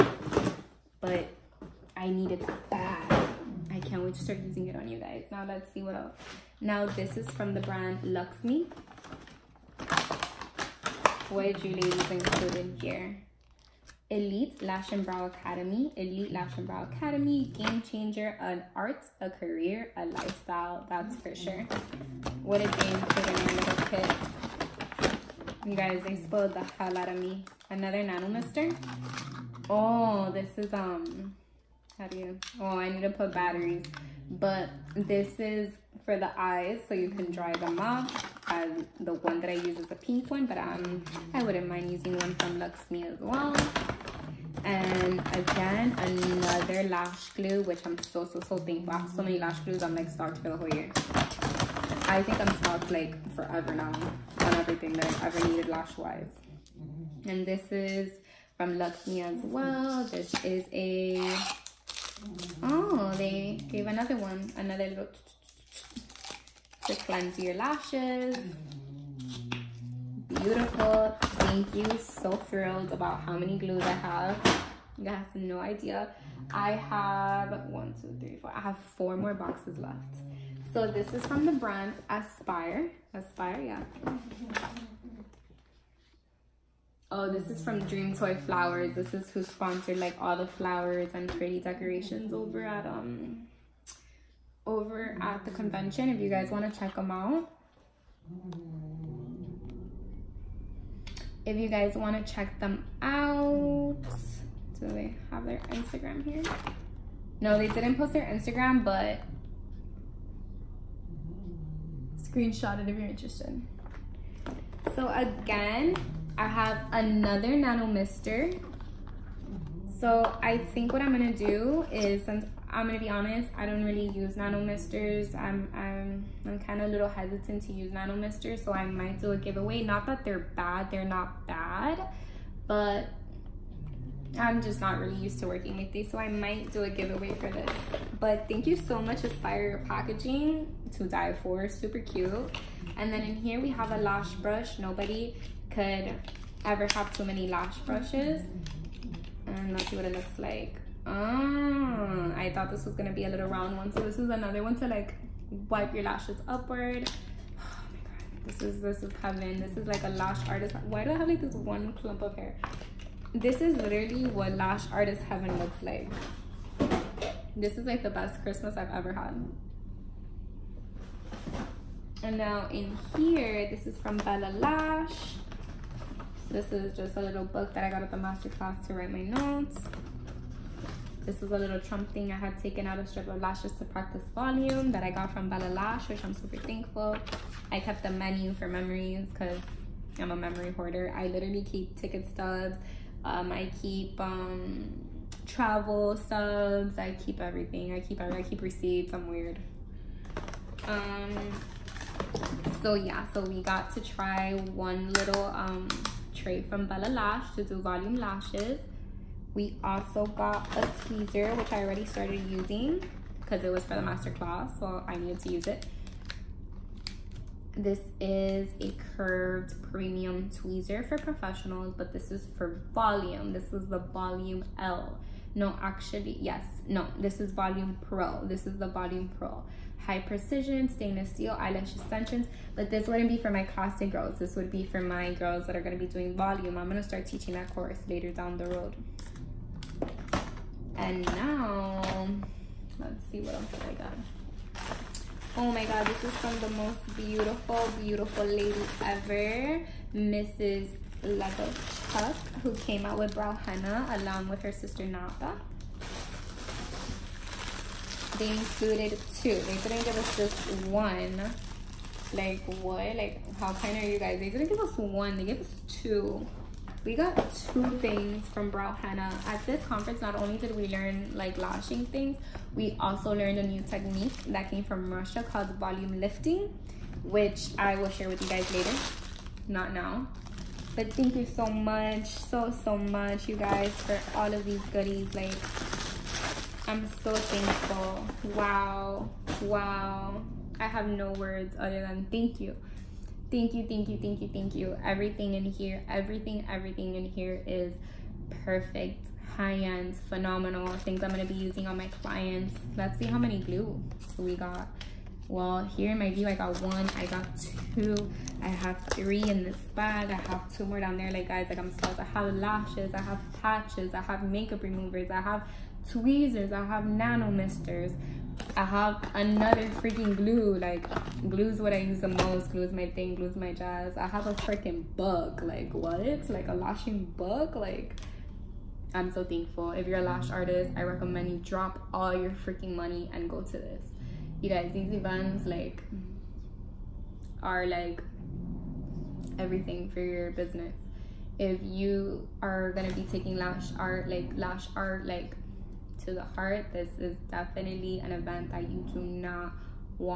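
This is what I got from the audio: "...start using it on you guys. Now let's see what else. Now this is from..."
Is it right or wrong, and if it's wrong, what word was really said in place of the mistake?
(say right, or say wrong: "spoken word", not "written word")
right.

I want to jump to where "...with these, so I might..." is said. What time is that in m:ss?
2:15.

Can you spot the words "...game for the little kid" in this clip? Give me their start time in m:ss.
0:22.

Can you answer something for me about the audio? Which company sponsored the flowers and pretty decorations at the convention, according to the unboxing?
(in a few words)
Dream Toy Flowers.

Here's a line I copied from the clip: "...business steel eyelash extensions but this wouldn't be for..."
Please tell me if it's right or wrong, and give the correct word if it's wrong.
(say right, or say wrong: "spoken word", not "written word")
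wrong: "stainless", not "business".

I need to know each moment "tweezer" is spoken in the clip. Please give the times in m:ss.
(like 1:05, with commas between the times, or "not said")
3:30, 3:40, 5:16.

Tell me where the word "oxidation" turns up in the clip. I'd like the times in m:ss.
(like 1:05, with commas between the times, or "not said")
not said.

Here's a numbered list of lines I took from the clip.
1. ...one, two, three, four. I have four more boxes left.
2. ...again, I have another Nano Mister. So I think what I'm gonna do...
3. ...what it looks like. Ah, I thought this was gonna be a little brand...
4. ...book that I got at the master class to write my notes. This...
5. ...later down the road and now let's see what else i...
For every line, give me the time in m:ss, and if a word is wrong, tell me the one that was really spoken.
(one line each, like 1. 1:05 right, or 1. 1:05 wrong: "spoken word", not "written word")
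1. 1:17 right
2. 1:55 right
3. 2:29 wrong: "round", not "brand"
4. 2:57 right
5. 3:58 right.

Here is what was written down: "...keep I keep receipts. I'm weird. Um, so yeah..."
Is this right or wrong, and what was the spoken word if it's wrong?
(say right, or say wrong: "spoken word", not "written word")
right.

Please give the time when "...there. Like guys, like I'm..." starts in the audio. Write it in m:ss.
5:11.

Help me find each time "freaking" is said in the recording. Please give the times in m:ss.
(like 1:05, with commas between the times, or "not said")
5:19, 5:24, 5:32.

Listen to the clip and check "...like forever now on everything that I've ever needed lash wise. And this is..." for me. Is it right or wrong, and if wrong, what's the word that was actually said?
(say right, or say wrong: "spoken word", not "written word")
right.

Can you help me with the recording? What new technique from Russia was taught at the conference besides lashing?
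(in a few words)
volume lifting.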